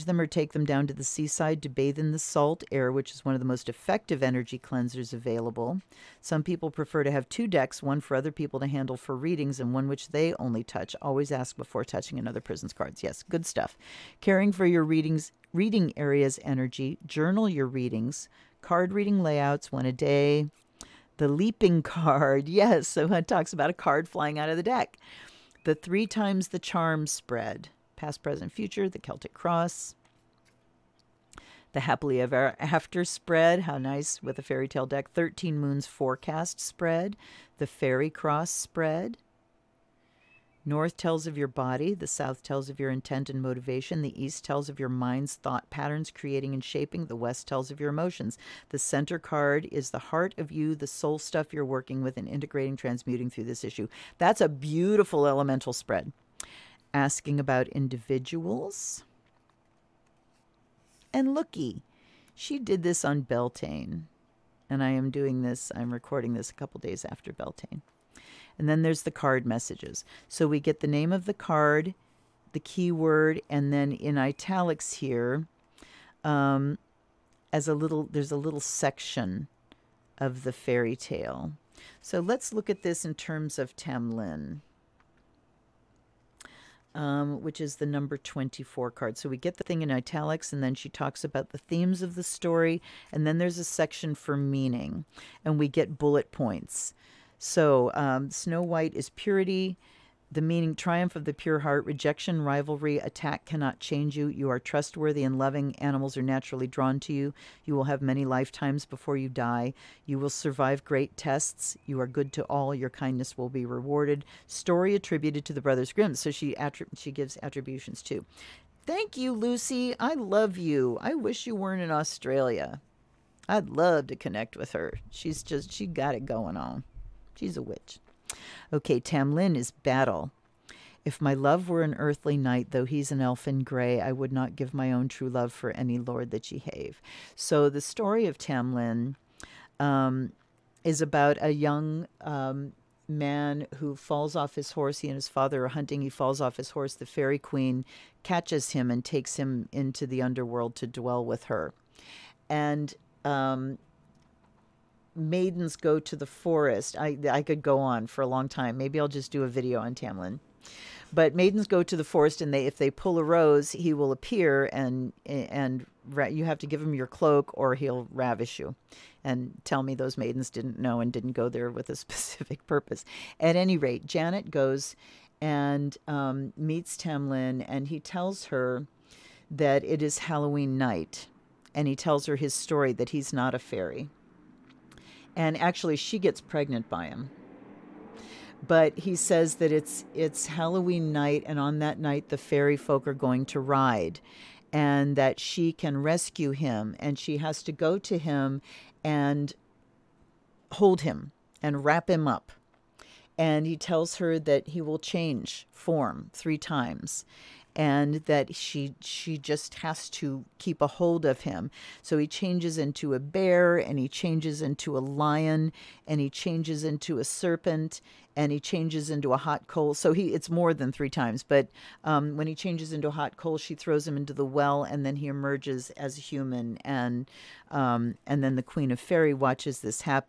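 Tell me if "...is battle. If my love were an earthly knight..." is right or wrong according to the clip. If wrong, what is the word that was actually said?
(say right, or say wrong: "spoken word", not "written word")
right.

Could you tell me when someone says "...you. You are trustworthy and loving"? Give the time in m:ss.
1:44.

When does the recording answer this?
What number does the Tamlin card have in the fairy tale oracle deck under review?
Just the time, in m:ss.
1:28.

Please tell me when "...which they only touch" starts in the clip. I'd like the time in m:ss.
0:09.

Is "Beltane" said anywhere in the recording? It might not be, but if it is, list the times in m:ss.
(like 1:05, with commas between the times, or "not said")
1:03, 1:07.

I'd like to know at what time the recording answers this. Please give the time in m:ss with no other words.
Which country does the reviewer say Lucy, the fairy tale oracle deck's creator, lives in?
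2:01.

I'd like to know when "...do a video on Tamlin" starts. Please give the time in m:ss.
2:39.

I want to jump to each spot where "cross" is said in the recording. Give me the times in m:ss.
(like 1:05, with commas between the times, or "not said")
0:29, 0:38.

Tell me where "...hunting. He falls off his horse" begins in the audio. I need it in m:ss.
2:25.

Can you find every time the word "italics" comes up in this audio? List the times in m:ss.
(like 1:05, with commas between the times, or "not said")
1:14, 1:29.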